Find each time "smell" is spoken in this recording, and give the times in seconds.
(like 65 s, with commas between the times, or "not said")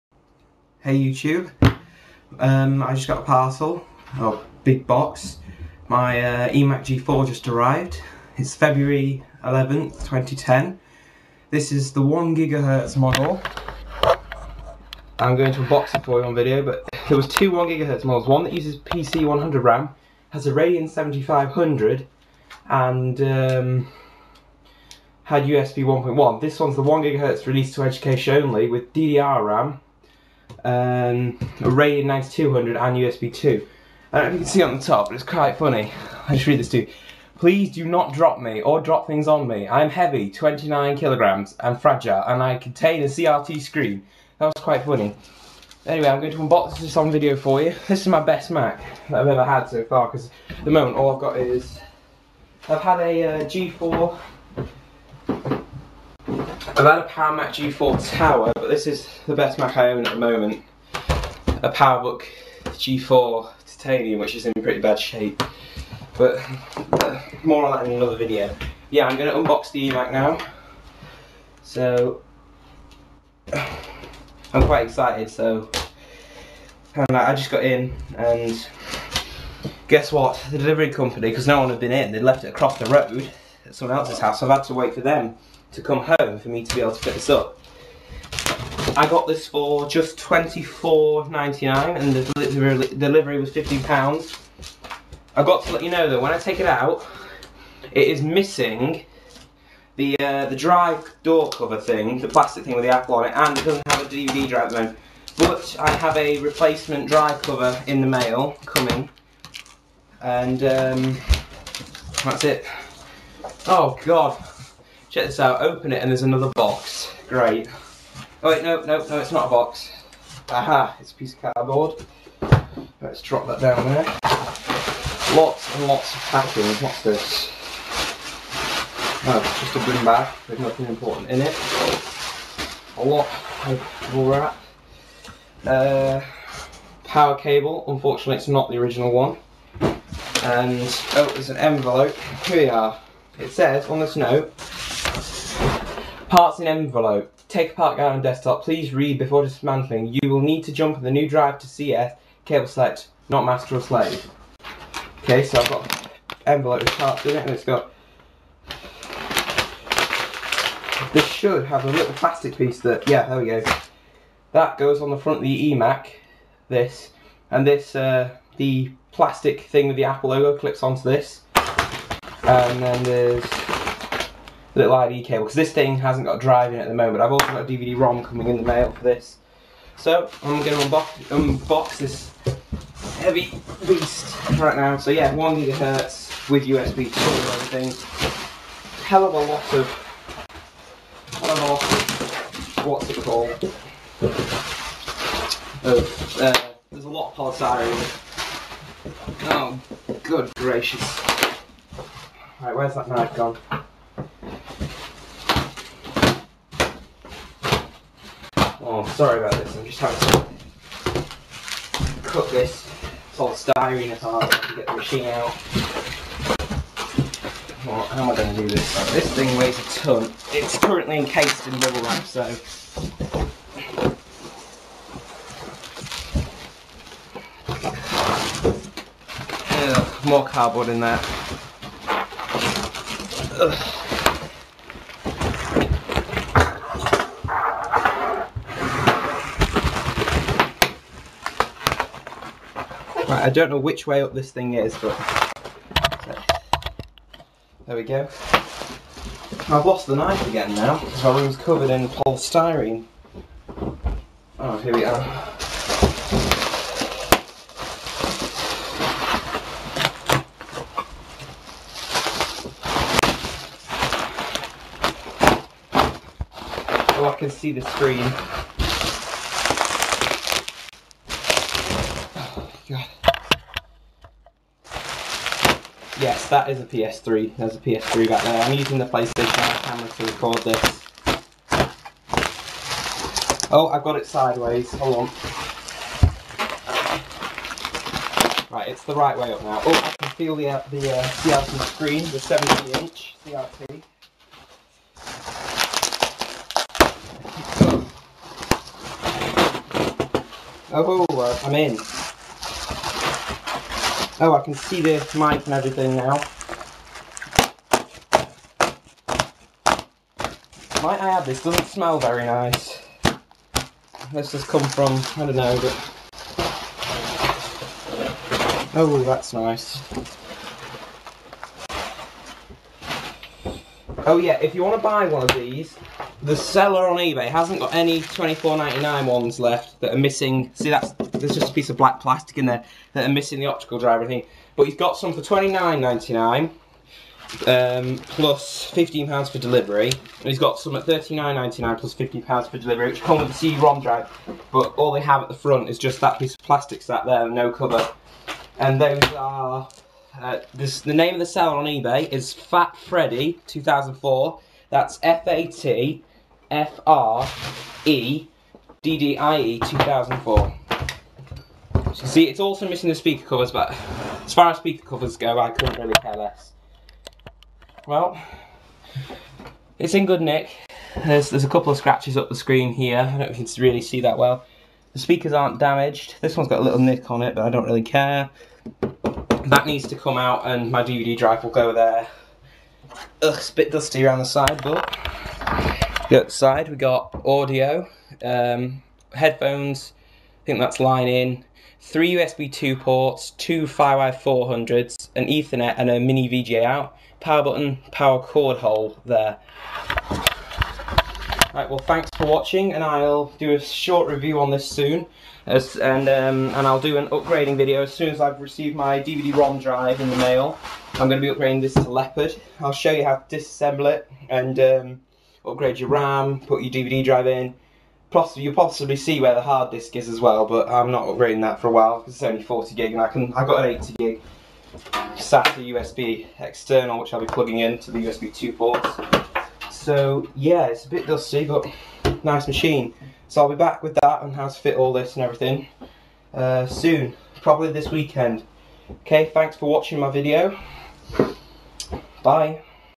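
311 s.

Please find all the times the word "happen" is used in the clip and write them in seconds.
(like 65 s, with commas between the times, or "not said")
not said.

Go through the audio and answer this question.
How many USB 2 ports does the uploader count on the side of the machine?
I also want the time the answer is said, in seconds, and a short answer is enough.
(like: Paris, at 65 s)
3, at 391 s.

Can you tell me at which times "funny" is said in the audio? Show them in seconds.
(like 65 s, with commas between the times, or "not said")
35 s, 44 s.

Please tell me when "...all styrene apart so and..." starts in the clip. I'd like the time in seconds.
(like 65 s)
213 s.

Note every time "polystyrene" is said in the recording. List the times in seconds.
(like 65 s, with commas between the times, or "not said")
197 s, 252 s.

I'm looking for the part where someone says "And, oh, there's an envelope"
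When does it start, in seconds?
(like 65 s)
140 s.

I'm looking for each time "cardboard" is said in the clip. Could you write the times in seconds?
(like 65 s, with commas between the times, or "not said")
121 s, 230 s.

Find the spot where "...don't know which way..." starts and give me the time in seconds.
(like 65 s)
243 s.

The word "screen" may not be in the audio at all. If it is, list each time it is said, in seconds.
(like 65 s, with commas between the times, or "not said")
43 s, 267 s, 291 s, 372 s.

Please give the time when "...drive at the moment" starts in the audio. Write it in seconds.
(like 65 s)
104 s.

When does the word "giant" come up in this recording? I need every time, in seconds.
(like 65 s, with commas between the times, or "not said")
not said.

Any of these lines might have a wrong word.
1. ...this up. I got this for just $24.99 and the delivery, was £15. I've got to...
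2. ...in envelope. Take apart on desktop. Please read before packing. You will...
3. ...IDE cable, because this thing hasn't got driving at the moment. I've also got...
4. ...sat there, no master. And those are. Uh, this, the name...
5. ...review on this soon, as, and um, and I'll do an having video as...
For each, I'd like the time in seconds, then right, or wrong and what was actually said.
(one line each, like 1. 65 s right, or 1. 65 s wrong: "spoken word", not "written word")
1. 87 s right
2. 146 s wrong: "dismantling", not "packing"
3. 174 s right
4. 347 s wrong: "cover", not "master"
5. 404 s wrong: "upgrading", not "having".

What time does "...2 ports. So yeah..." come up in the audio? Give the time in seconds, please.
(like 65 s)
428 s.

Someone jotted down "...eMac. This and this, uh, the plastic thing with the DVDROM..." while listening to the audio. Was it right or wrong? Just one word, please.
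wrong.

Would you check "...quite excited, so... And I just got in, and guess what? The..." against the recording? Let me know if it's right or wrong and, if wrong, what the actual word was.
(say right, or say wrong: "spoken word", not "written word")
right.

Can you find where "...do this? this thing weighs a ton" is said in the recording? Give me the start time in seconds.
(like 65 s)
218 s.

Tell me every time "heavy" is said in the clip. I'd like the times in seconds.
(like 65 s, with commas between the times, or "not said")
39 s, 183 s.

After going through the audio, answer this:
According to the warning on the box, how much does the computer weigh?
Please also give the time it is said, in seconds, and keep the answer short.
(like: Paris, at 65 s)
29 kilograms, at 40 s.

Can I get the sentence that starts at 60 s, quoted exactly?
A PowerBook G4 titanium, which is in pretty bad shape.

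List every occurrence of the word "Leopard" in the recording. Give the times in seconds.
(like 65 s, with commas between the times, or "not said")
412 s.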